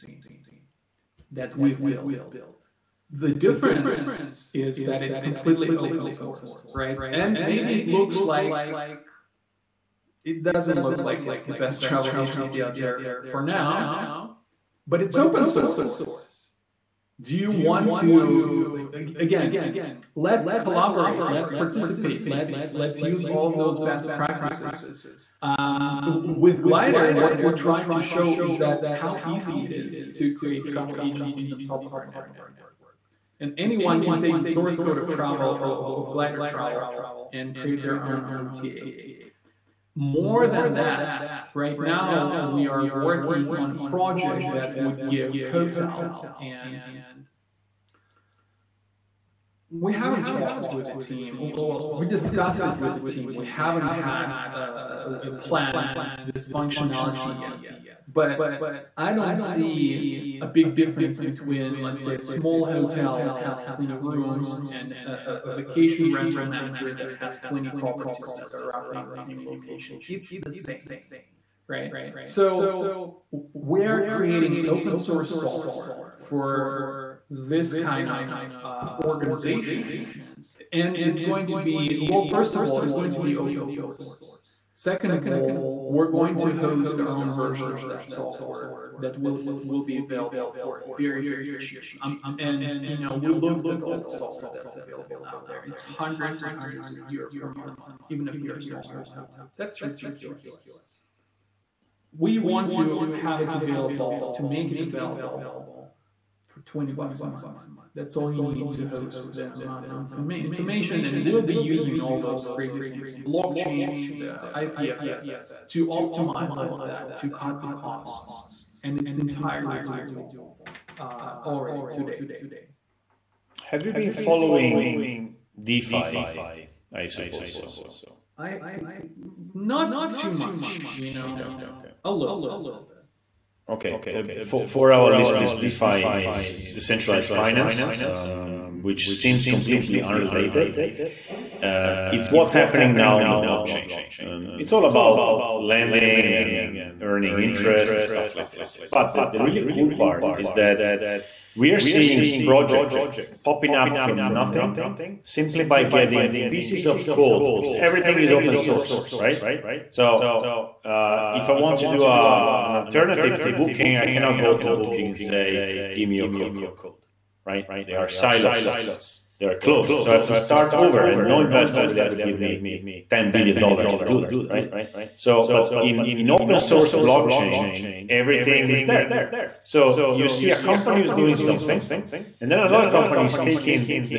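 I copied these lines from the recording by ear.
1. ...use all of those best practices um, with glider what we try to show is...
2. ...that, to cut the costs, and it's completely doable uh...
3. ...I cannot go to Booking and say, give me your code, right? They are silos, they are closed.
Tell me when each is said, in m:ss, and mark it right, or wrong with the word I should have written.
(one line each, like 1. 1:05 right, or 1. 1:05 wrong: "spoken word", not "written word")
1. 0:23 right
2. 1:56 wrong: "entirely", not "completely"
3. 2:43 right.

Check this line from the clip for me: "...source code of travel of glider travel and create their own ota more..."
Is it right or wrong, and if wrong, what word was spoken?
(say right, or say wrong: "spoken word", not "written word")
right.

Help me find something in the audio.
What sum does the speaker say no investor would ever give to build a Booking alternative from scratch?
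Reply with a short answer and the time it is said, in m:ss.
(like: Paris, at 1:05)
$10 billion, at 2:53.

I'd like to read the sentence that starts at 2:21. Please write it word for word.
Uh, it's what's happening now on the blockchain.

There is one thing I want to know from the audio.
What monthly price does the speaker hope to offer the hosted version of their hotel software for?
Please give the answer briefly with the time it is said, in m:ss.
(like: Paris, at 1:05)
20 bucks a month, at 1:46.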